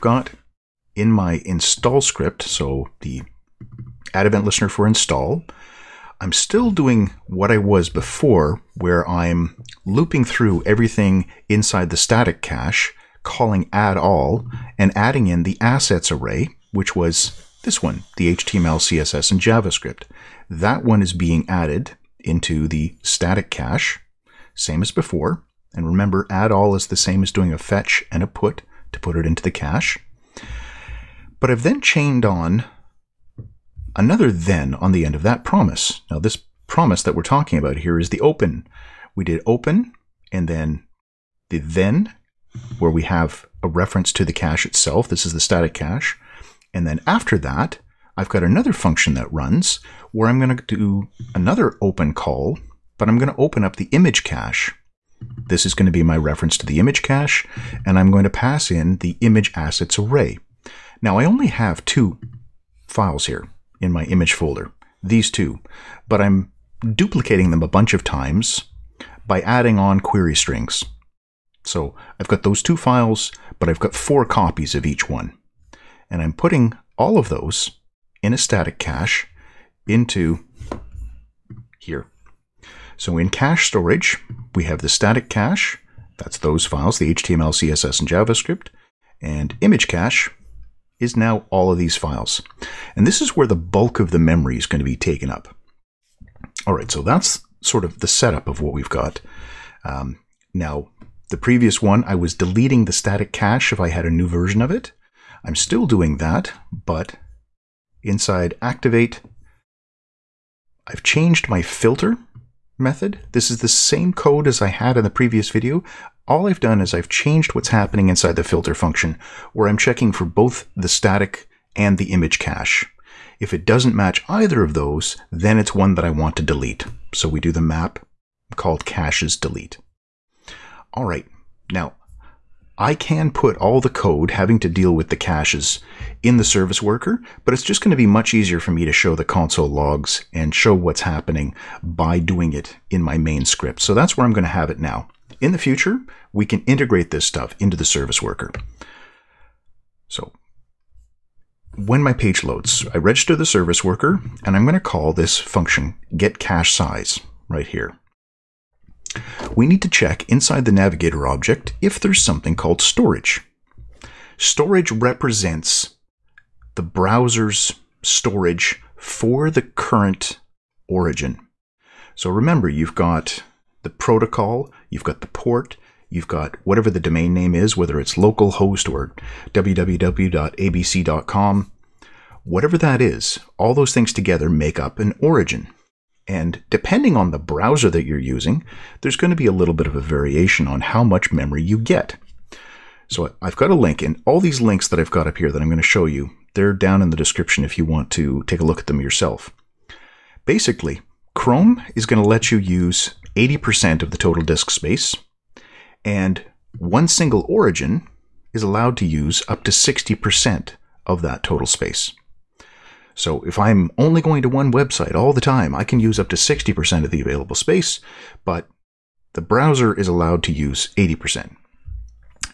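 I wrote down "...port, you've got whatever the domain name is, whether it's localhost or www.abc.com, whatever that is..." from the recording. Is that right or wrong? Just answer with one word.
right.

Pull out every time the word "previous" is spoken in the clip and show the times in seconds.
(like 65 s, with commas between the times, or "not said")
101 s, 115 s.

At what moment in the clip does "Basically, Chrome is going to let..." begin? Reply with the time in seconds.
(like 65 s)
200 s.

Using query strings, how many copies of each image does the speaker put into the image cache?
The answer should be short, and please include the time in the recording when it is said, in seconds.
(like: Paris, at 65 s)
4, at 73 s.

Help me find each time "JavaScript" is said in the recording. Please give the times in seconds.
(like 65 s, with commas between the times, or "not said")
19 s, 88 s.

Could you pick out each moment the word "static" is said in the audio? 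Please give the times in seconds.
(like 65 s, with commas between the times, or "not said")
11 s, 23 s, 45 s, 78 s, 84 s, 102 s, 120 s.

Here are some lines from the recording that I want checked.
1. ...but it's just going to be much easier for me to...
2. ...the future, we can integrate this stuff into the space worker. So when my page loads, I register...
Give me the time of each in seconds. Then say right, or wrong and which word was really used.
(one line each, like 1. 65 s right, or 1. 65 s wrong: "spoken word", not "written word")
1. 137 s right
2. 145 s wrong: "service", not "space".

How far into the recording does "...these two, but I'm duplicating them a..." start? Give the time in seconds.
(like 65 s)
65 s.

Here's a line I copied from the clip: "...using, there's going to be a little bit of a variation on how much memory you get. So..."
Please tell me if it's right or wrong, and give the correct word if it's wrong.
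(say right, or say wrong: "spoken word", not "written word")
right.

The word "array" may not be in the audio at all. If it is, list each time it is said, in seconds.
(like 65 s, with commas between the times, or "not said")
16 s, 59 s.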